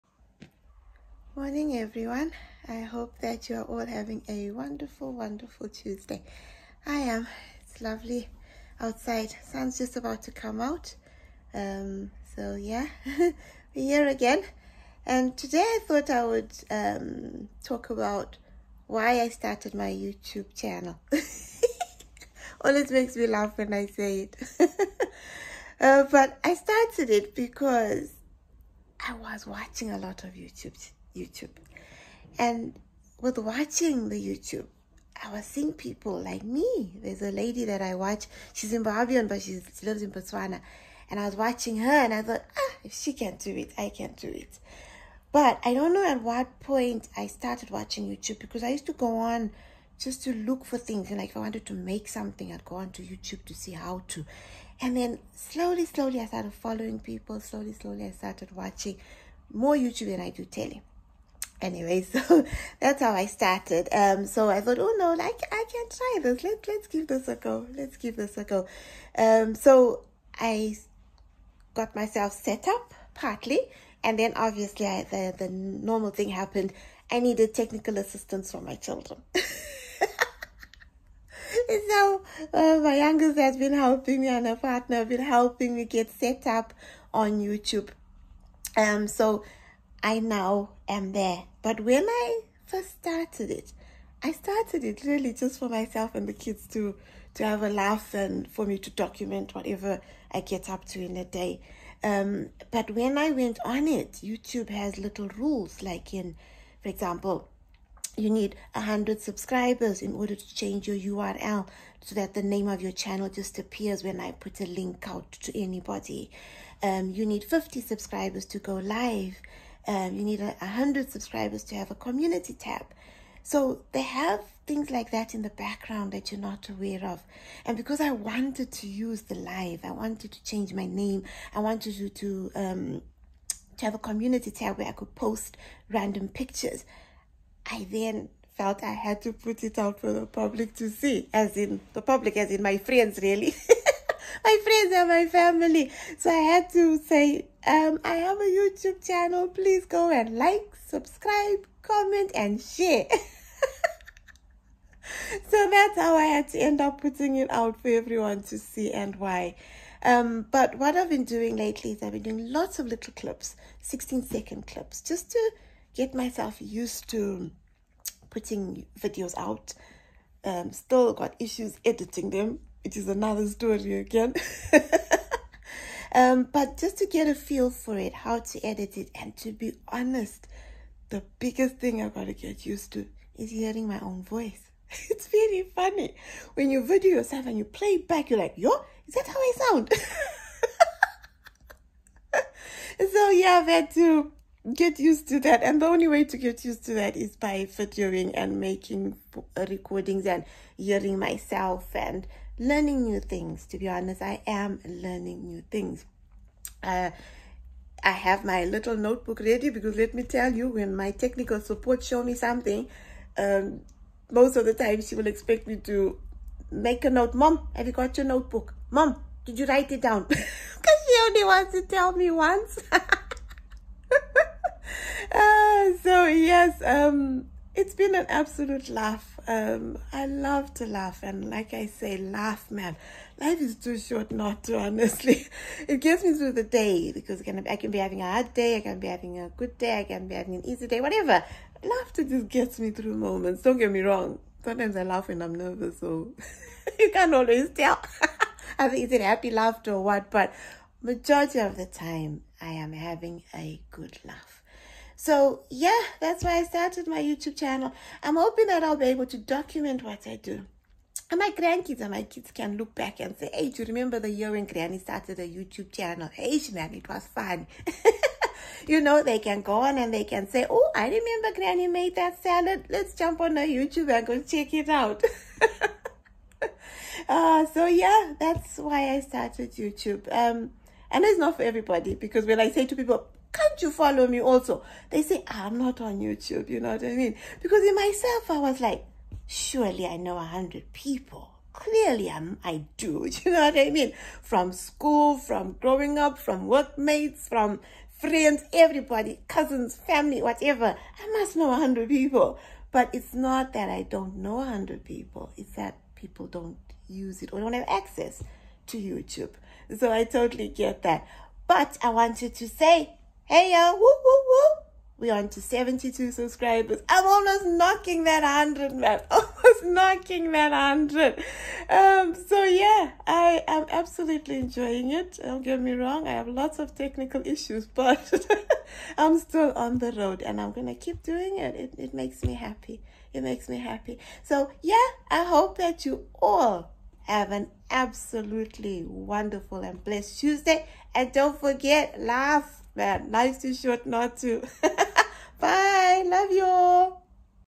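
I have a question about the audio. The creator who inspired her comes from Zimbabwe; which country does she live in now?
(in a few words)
Botswana.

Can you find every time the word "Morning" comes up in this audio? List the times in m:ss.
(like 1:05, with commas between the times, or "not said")
0:01.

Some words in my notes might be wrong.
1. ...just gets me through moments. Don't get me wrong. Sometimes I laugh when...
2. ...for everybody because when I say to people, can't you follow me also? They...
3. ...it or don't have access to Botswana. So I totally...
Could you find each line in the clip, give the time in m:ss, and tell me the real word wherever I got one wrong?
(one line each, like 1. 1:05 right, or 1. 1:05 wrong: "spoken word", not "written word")
1. 4:02 right
2. 4:41 right
3. 5:07 wrong: "YouTube", not "Botswana".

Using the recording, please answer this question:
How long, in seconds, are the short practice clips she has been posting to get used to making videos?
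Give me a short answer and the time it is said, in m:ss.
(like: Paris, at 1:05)
16 seconds, at 2:43.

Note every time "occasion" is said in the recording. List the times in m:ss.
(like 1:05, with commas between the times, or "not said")
not said.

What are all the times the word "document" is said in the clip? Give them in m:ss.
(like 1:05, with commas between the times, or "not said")
1:38, 4:19.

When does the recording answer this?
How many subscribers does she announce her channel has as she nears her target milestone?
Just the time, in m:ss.
5:15.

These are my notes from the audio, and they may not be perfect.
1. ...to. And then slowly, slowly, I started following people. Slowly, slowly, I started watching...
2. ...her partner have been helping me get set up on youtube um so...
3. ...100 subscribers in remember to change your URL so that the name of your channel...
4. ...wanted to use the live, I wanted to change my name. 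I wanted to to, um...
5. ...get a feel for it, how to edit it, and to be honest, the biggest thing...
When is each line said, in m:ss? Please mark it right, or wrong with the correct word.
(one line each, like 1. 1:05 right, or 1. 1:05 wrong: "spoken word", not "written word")
1. 0:54 right
2. 1:24 right
3. 1:48 wrong: "order", not "remember"
4. 2:08 right
5. 2:57 right.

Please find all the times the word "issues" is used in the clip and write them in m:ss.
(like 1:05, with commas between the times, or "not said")
2:51, 5:27.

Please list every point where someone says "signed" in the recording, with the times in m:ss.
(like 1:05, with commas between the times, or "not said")
not said.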